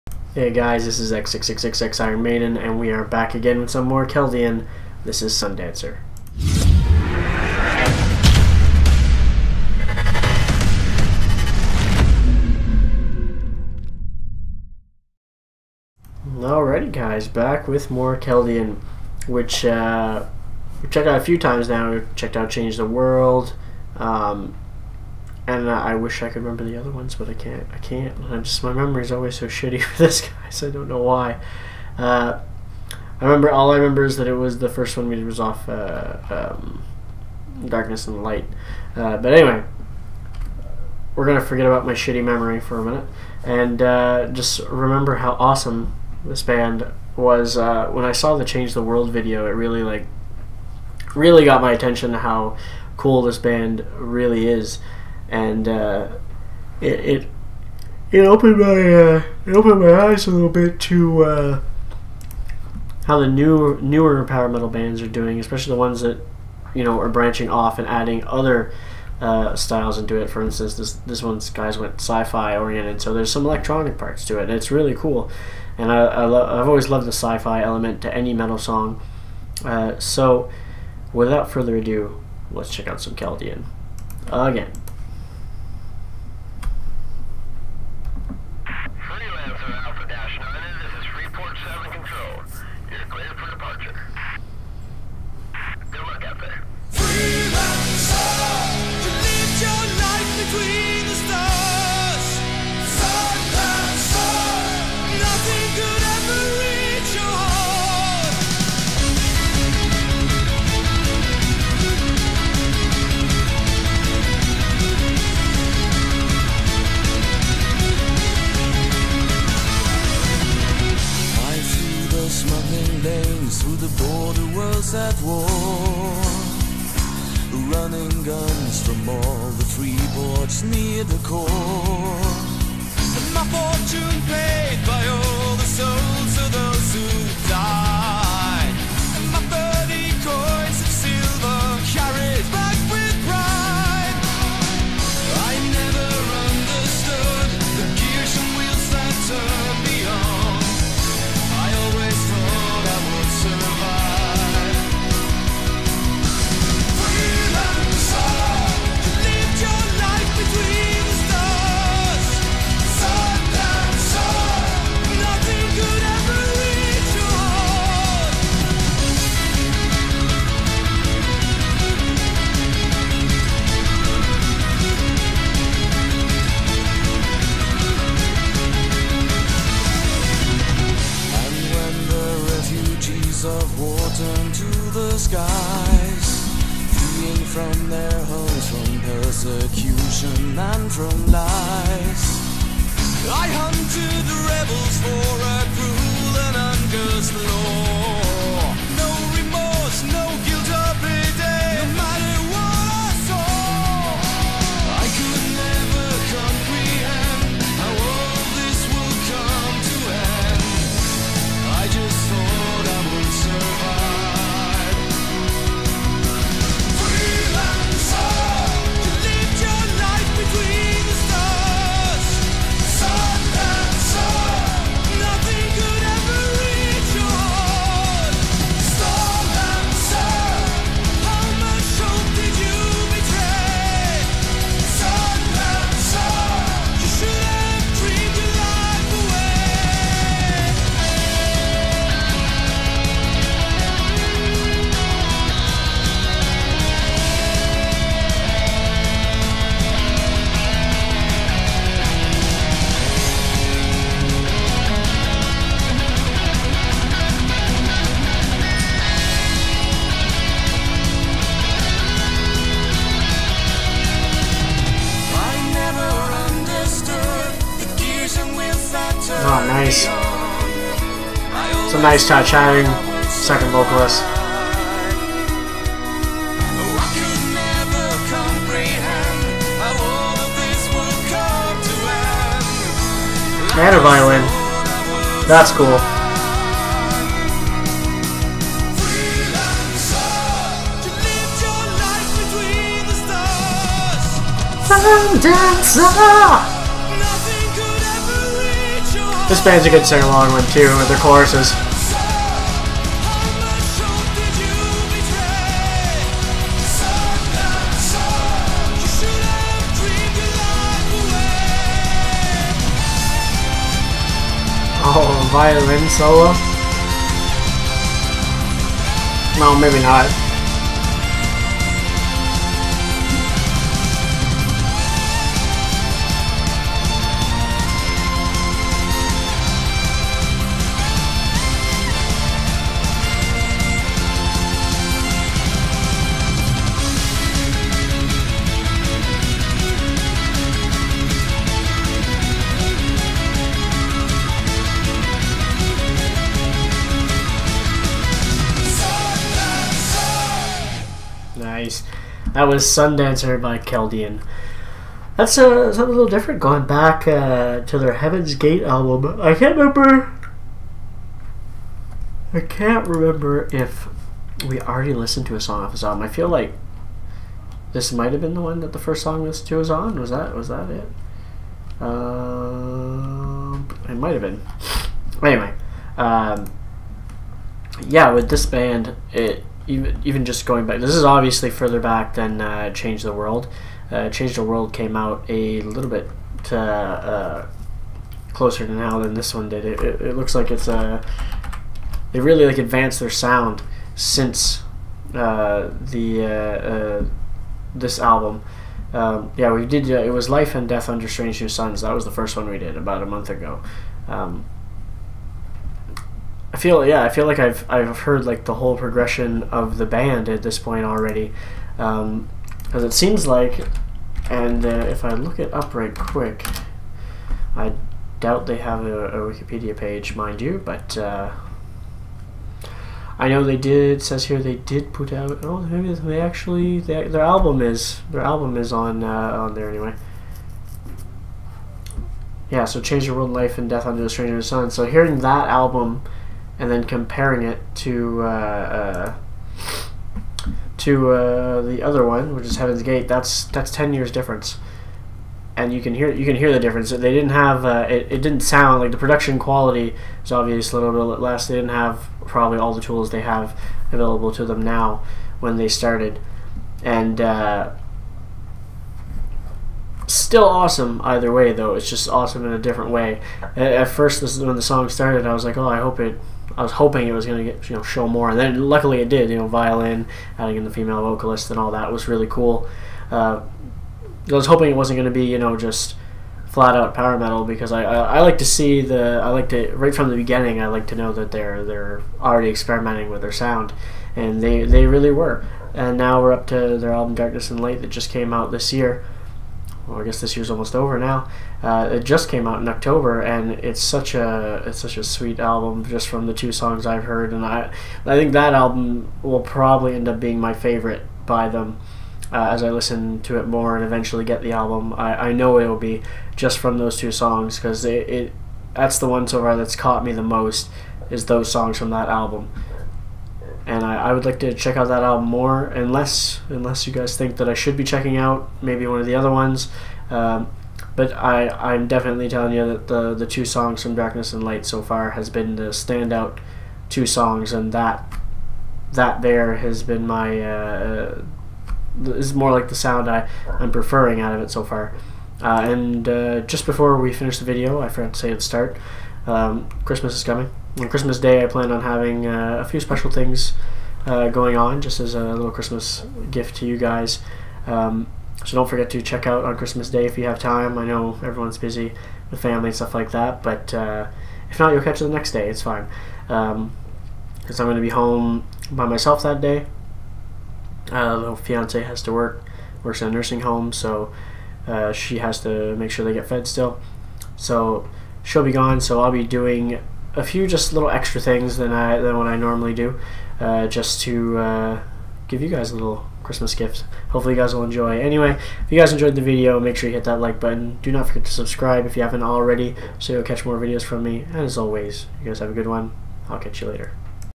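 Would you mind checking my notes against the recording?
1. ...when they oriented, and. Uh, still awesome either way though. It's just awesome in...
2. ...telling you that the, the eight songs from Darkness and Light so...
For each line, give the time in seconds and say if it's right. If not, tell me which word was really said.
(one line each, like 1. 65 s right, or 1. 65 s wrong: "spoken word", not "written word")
1. 455 s wrong: "started", not "oriented"
2. 522 s wrong: "two", not "eight".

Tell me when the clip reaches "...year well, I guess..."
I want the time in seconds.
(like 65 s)
488 s.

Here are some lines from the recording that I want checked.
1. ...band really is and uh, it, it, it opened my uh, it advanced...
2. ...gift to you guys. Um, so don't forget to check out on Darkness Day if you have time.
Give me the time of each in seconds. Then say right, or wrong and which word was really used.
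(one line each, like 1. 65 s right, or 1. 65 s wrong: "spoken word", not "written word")
1. 53 s wrong: "opened", not "advanced"
2. 546 s wrong: "Christmas", not "Darkness".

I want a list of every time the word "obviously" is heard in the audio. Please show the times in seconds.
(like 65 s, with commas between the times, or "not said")
381 s, 450 s.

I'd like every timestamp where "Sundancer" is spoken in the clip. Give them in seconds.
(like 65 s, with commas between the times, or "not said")
5 s, 352 s.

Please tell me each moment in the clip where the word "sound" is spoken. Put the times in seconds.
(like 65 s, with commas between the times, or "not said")
393 s, 448 s, 483 s, 532 s.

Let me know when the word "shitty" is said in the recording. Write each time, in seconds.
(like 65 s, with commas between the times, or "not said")
29 s, 41 s.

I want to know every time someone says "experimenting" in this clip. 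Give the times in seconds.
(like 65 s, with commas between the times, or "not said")
482 s.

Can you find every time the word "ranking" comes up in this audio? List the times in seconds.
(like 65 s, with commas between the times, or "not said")
not said.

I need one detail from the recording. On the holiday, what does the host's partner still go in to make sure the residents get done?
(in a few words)
fed.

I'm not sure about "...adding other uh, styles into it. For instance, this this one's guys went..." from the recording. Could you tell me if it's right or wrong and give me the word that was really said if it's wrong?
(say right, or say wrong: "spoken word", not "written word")
right.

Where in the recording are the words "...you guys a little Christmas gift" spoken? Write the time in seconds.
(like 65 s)
575 s.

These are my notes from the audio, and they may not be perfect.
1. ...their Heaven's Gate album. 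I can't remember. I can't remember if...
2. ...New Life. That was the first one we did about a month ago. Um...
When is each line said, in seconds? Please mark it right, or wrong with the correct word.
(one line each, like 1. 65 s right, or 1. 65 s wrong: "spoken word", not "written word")
1. 357 s right
2. 401 s wrong: "Suns", not "Life".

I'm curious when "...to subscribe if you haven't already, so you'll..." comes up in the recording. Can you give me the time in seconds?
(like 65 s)
581 s.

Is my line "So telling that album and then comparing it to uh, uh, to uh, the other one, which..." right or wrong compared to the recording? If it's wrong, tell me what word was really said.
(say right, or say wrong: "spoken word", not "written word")
wrong: "hearing", not "telling".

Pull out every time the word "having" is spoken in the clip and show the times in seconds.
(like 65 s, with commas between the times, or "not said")
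542 s.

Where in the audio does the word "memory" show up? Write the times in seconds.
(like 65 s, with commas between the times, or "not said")
28 s, 42 s.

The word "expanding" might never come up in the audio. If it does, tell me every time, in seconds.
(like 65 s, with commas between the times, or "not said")
not said.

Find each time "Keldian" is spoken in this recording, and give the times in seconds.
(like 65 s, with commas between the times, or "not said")
4 s, 18 s, 83 s, 353 s.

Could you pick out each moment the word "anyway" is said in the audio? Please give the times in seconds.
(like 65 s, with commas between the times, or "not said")
39 s, 375 s, 429 s, 578 s.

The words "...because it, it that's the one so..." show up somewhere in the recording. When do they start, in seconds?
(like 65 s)
507 s.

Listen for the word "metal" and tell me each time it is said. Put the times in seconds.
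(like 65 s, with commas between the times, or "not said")
64 s, 78 s, 477 s.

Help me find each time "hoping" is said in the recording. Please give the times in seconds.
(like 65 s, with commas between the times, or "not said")
466 s, 474 s.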